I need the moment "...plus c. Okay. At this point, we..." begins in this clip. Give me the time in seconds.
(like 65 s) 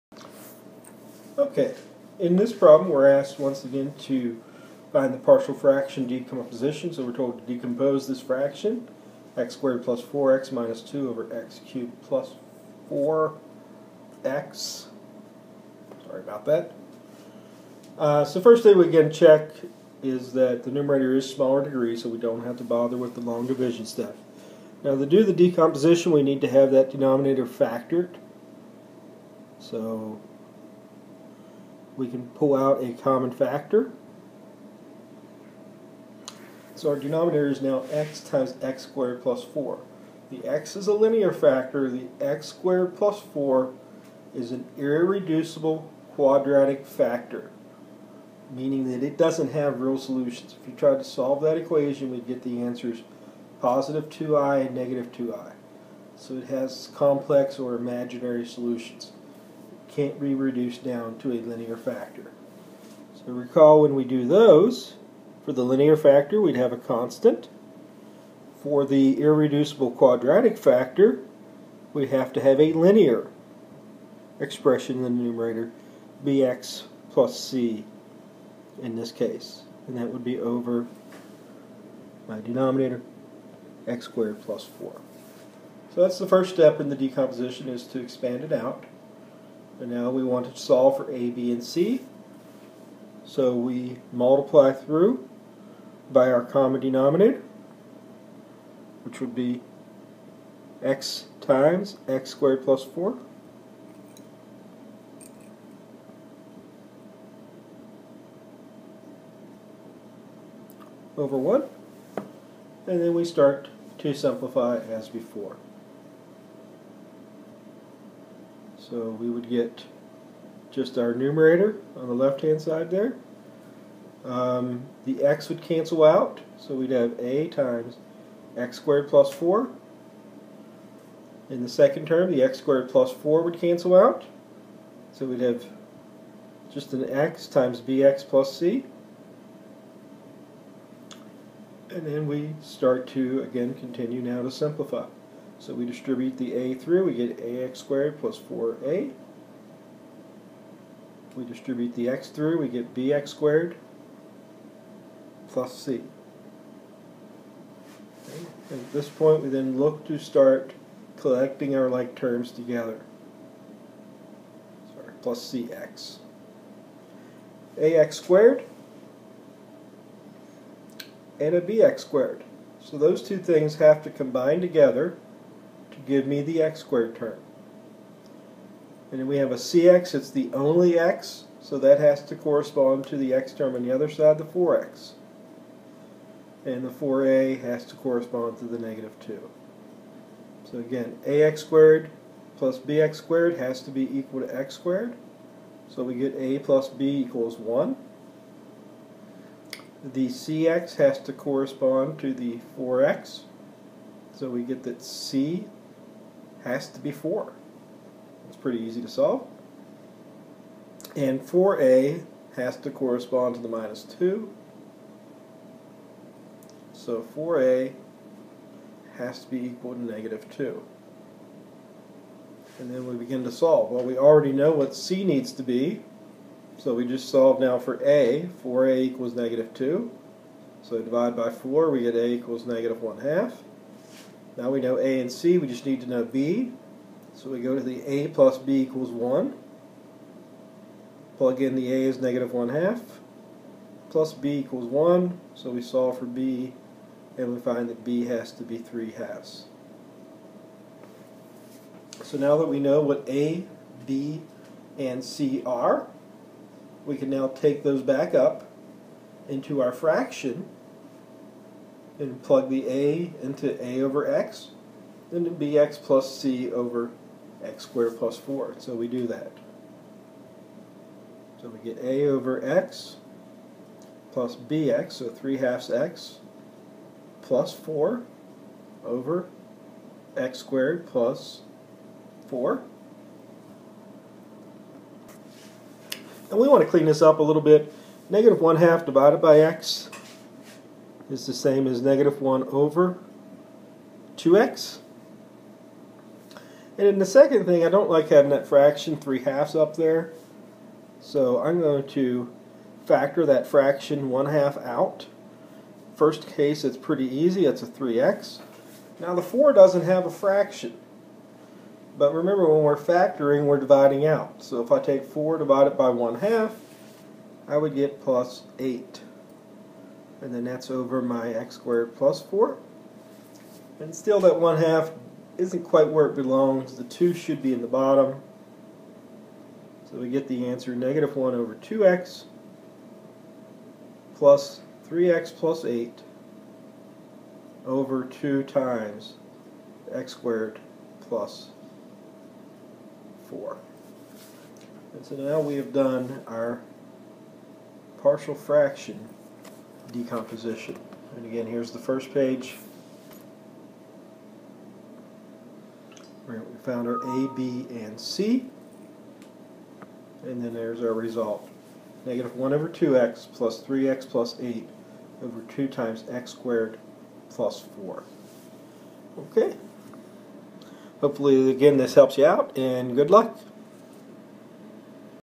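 155 s.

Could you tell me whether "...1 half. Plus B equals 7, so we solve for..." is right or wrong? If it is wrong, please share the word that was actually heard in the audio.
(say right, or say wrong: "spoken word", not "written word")
wrong: "1", not "7".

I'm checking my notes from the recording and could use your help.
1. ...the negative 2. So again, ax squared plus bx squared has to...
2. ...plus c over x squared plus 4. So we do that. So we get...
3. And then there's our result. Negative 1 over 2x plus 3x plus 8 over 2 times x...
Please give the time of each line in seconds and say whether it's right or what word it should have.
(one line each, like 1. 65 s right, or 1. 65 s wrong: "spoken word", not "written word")
1. 188 s right
2. 265 s right
3. 360 s right.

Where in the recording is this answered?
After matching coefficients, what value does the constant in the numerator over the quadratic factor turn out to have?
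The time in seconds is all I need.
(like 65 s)
205 s.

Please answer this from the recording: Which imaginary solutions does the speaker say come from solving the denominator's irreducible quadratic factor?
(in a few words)
2i and -2i.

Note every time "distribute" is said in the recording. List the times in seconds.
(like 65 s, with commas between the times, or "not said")
145 s, 151 s.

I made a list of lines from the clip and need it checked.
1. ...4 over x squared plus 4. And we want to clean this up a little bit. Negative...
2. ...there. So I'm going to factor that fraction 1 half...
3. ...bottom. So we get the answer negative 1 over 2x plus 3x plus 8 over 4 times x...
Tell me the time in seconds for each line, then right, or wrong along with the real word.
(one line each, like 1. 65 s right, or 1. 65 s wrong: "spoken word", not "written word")
1. 277 s right
2. 299 s right
3. 327 s wrong: "2", not "4".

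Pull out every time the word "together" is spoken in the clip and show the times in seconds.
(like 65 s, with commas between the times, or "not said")
162 s, 174 s.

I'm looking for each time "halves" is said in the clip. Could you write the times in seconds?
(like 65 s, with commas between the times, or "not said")
249 s, 275 s, 299 s.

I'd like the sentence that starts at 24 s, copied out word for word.
Now to do the decomposition, we need to have that denominator factored.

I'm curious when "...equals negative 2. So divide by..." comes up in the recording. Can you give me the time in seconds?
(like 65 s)
229 s.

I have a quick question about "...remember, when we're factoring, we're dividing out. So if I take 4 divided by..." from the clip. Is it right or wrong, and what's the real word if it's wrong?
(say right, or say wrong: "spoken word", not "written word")
right.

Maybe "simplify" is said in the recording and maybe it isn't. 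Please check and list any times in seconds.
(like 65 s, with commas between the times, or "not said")
114 s, 144 s.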